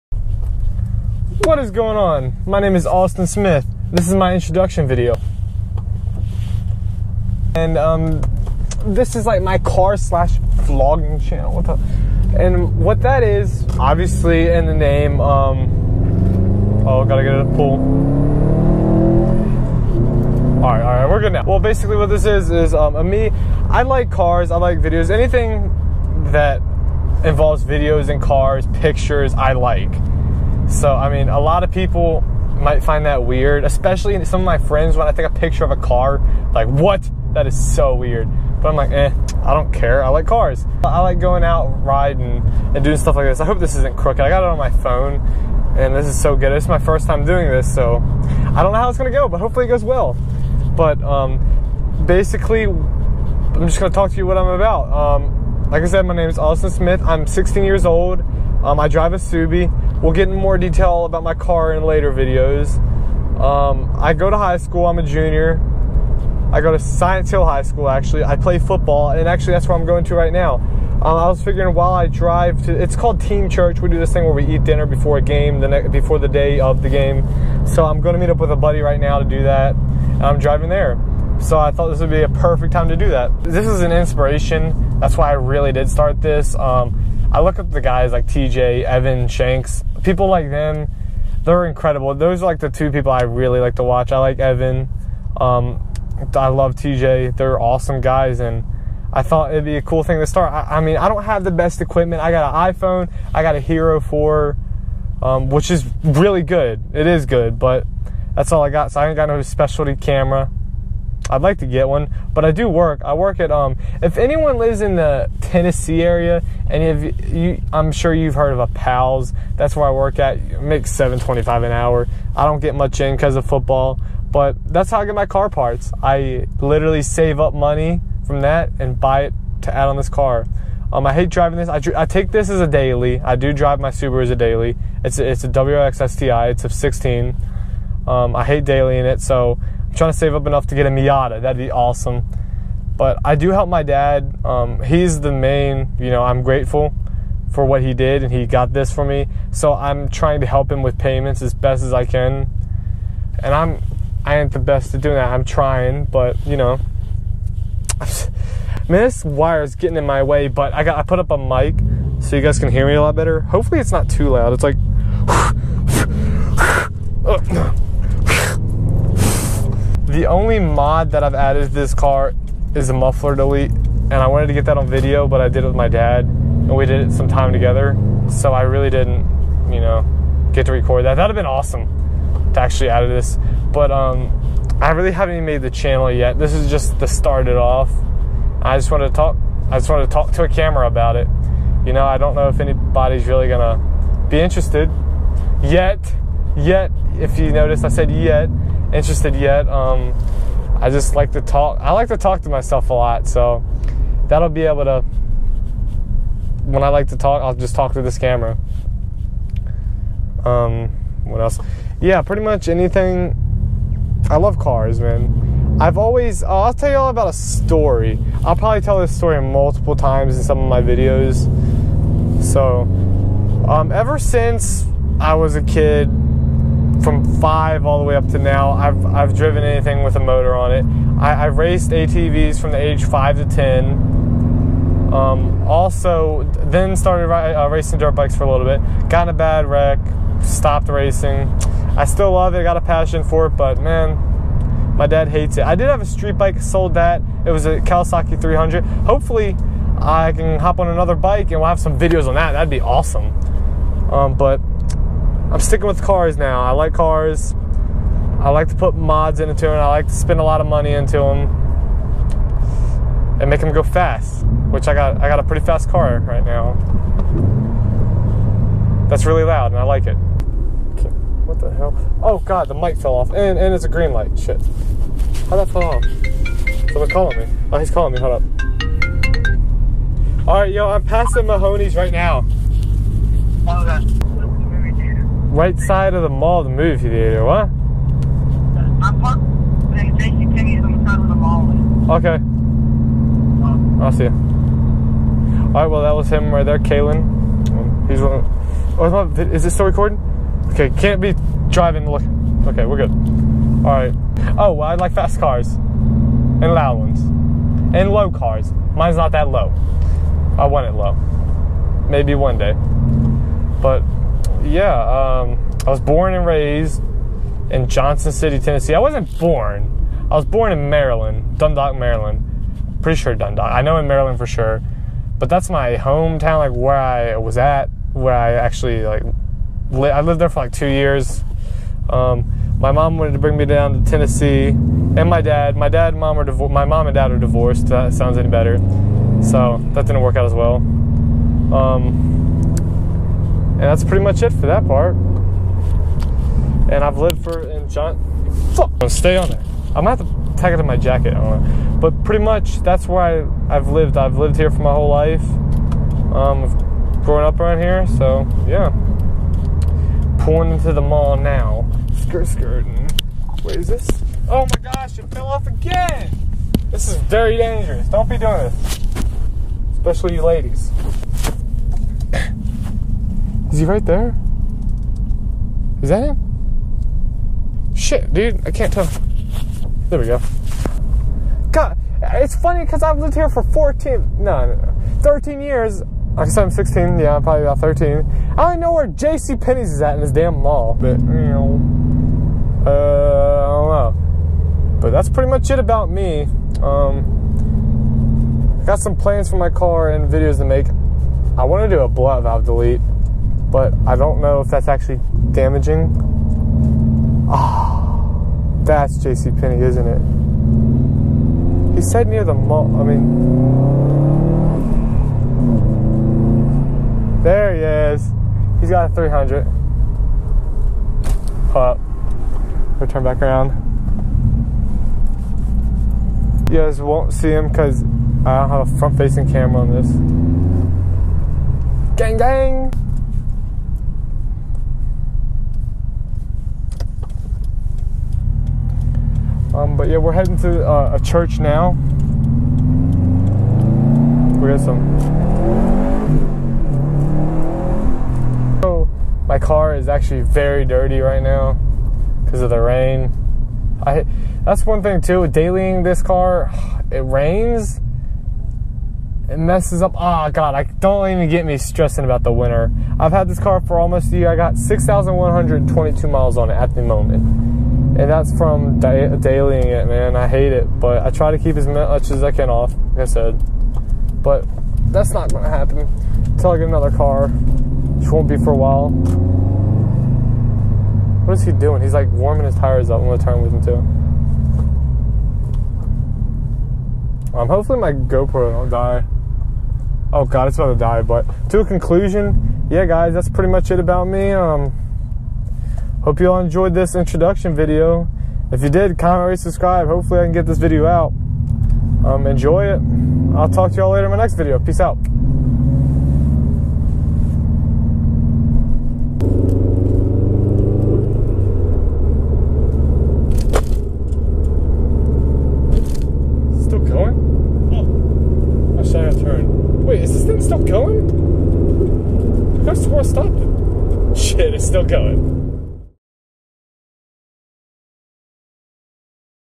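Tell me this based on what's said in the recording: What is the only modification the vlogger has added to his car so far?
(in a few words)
muffler delete.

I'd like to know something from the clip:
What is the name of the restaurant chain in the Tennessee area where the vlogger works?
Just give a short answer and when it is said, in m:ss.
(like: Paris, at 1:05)
Pals, at 1:58.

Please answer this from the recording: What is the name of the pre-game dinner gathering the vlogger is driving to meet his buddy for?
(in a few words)
Team Church.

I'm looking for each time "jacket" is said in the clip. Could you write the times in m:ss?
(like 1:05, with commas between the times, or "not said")
5:50.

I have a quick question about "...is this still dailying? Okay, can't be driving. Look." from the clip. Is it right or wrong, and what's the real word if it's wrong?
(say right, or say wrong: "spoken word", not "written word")
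wrong: "recording", not "dailying".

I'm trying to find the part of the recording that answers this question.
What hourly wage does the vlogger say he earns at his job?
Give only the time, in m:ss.
2:00.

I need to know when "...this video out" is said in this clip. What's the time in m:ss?
8:20.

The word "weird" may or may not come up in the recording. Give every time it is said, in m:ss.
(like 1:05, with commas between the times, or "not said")
0:33, 0:37.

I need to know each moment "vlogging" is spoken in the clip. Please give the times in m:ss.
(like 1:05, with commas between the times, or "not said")
0:10.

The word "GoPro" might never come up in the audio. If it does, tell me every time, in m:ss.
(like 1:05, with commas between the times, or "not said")
8:08.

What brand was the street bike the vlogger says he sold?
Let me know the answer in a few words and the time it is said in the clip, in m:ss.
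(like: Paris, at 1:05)
Kawasaki, at 4:07.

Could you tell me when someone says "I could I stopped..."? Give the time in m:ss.
8:42.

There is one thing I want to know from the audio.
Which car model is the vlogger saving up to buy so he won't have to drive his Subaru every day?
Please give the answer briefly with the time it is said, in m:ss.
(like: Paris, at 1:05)
Miata, at 2:20.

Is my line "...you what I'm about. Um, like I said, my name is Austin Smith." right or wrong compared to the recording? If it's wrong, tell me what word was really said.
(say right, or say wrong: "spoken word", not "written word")
right.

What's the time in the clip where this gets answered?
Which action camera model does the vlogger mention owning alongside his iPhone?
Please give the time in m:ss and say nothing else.
1:43.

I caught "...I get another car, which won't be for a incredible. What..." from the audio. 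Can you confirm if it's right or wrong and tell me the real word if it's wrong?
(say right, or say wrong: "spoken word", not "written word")
wrong: "while", not "incredible".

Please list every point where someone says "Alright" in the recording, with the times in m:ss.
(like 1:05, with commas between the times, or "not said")
4:54, 5:03.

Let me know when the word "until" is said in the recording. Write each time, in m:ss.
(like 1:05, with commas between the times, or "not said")
7:56.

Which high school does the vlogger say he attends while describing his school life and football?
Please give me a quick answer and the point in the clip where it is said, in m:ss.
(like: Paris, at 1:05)
Science Hill High School, at 1:06.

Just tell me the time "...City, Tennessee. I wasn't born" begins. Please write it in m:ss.
5:18.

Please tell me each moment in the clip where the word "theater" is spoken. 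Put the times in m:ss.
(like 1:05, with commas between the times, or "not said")
4:47.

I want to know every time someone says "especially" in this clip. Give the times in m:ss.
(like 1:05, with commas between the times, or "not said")
0:33, 6:09.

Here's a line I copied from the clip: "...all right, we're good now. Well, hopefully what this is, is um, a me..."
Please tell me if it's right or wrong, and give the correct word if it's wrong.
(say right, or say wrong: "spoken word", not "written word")
wrong: "basically", not "hopefully".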